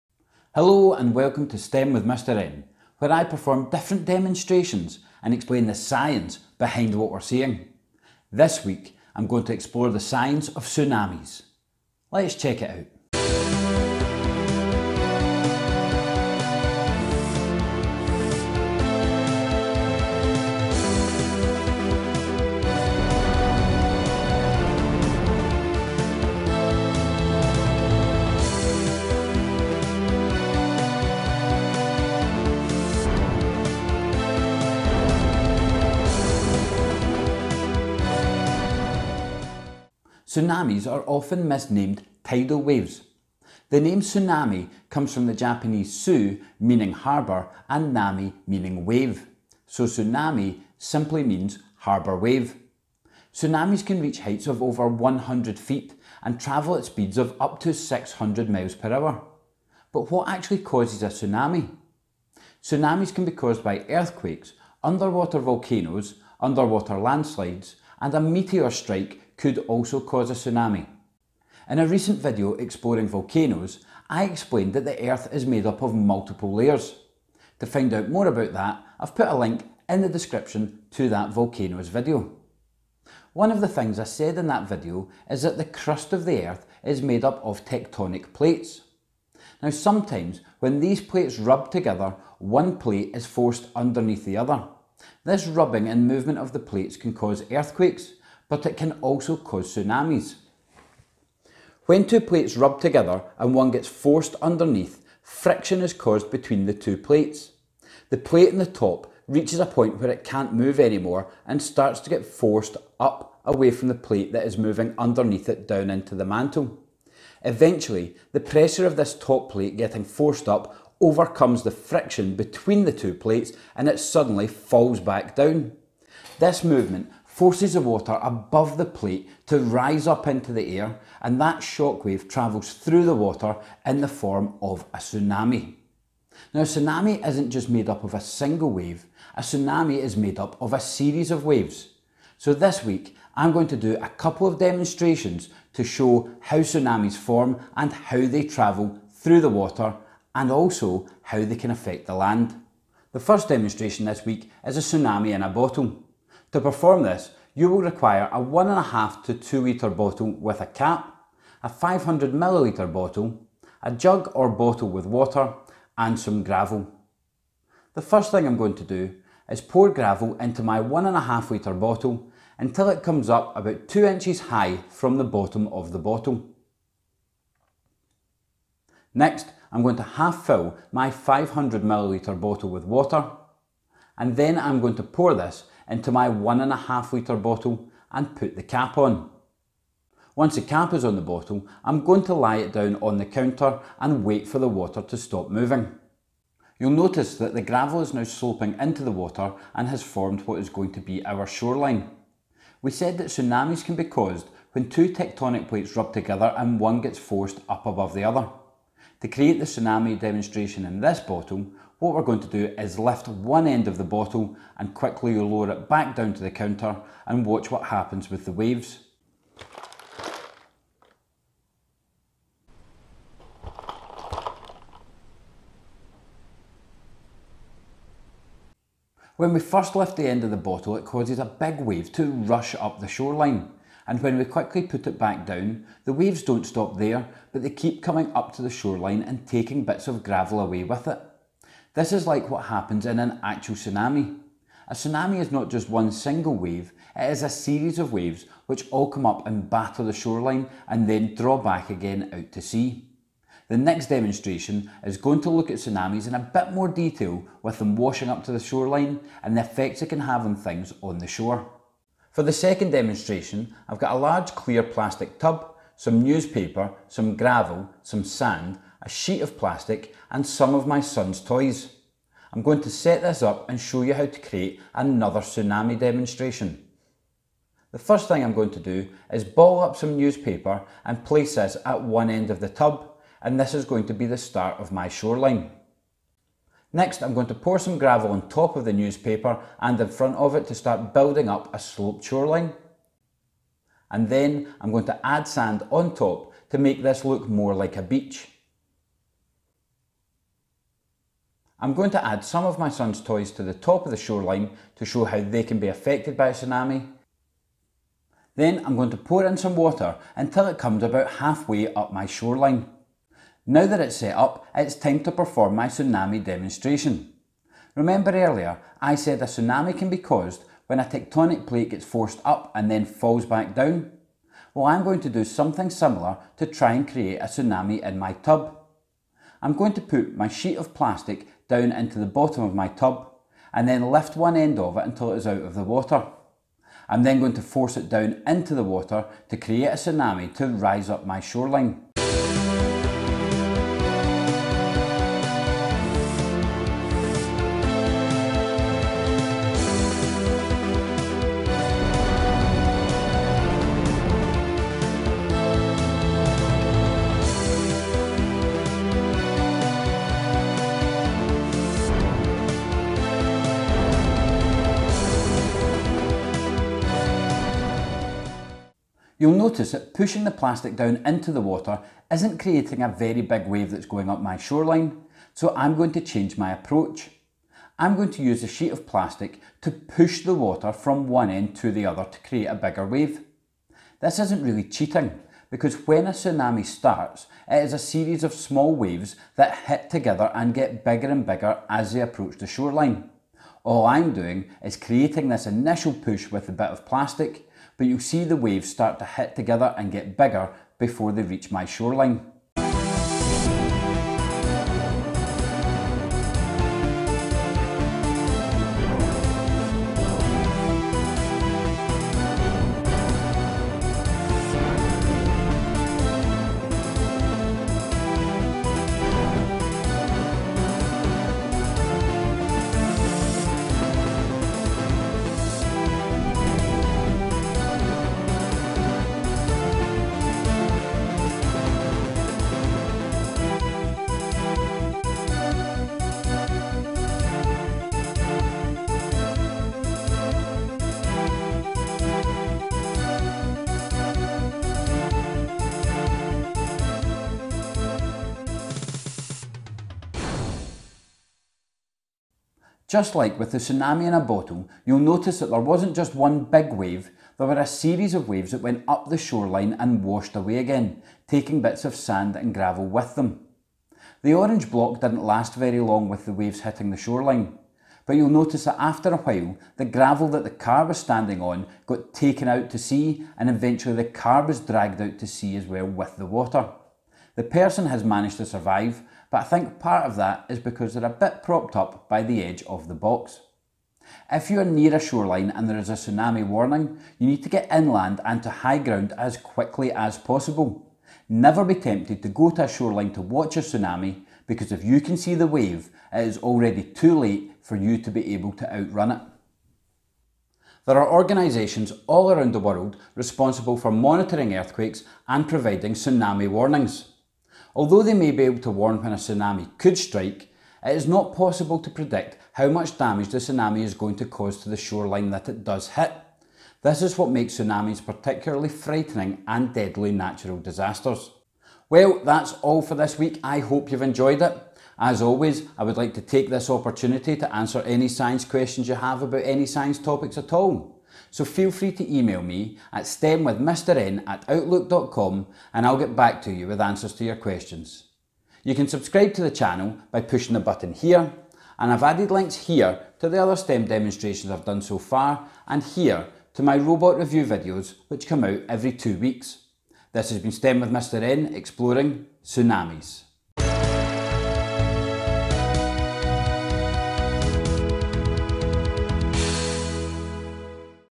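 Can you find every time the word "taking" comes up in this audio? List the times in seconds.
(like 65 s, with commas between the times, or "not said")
239 s, 461 s.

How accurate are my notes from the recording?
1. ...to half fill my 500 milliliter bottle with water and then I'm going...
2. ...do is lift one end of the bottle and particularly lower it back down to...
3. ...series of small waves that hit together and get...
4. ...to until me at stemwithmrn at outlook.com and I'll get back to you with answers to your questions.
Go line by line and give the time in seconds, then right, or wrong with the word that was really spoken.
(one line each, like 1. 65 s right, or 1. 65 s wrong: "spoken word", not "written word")
1. 179 s right
2. 212 s wrong: "quickly", not "particularly"
3. 387 s right
4. 532 s wrong: "email", not "until".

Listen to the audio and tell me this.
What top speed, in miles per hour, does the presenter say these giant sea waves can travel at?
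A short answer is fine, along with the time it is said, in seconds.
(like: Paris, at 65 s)
600, at 57 s.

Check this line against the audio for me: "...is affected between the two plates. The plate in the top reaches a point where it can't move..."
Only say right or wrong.
wrong.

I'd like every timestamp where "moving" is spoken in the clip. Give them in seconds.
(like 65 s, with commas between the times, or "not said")
114 s, 195 s.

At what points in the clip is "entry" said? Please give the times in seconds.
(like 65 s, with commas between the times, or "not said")
not said.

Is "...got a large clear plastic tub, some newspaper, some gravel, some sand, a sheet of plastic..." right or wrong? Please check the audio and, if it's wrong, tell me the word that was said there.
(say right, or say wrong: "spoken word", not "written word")
right.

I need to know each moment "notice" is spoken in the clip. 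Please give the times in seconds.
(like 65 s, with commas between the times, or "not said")
196 s, 369 s, 455 s, 468 s.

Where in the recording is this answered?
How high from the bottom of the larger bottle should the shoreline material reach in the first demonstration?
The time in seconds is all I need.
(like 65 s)
173 s.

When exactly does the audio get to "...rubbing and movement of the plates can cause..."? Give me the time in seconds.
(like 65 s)
95 s.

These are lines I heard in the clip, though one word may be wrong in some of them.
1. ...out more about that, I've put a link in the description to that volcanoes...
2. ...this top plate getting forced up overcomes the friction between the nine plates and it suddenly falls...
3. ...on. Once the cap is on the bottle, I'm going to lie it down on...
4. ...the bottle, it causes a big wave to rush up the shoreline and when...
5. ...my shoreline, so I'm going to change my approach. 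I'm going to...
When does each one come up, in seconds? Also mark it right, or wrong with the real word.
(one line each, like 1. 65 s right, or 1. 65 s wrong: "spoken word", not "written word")
1. 77 s right
2. 118 s wrong: "two", not "nine"
3. 188 s right
4. 230 s right
5. 374 s right.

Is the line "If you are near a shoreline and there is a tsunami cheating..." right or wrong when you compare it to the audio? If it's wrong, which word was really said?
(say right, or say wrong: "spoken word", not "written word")
wrong: "warning", not "cheating".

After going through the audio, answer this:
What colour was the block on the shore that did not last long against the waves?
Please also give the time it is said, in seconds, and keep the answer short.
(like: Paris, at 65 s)
Orange, at 464 s.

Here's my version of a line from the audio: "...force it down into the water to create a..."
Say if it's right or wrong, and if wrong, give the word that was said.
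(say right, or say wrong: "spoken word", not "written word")
right.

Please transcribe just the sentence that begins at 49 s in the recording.
So tsunami simply means harbour wave.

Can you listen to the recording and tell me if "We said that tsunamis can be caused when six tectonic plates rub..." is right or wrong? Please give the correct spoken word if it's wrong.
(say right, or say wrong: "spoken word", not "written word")
wrong: "two", not "six".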